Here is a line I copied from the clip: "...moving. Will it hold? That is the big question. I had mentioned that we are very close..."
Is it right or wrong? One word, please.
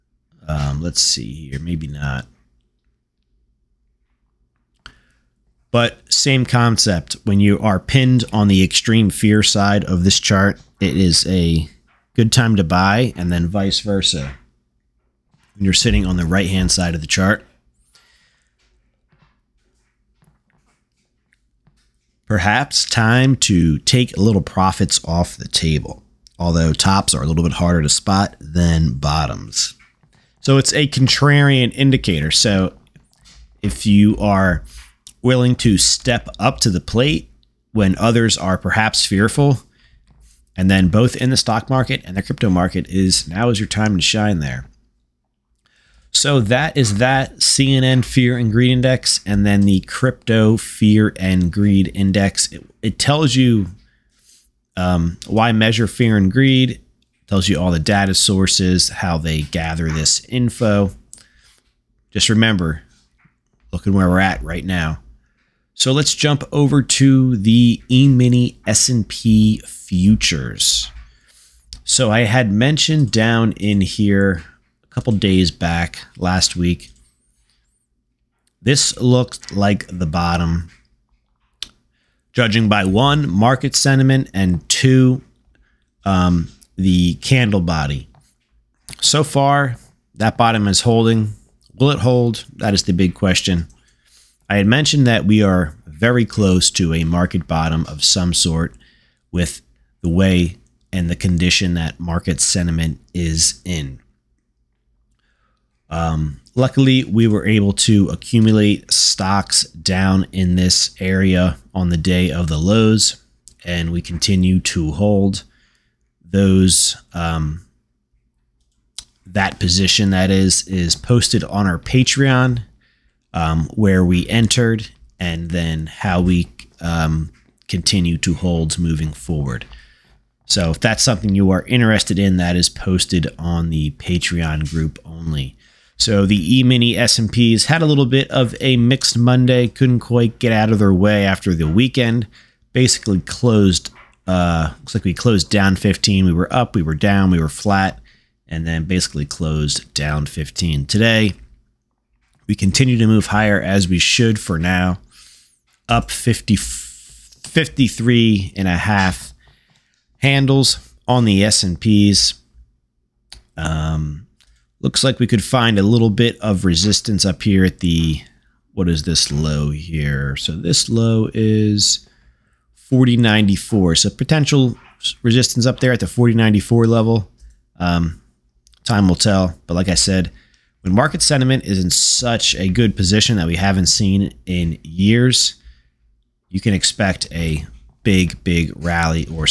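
wrong.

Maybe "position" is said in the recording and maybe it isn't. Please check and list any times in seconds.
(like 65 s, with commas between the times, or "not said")
119 s, 182 s.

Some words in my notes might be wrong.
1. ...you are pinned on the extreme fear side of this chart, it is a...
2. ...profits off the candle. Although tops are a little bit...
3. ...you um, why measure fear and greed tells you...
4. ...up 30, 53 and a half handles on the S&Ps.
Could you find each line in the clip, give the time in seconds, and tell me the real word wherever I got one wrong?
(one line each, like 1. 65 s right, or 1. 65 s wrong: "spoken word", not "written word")
1. 7 s right
2. 24 s wrong: "table", not "candle"
3. 53 s right
4. 155 s wrong: "50", not "30".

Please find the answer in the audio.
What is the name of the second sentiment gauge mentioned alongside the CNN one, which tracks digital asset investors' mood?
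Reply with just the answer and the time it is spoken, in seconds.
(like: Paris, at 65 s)
Crypto Fear and Greed Index, at 49 s.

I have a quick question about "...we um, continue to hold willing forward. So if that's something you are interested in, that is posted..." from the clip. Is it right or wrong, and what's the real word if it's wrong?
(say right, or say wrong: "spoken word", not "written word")
wrong: "moving", not "willing".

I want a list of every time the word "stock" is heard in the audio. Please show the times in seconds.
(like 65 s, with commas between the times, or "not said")
41 s, 108 s.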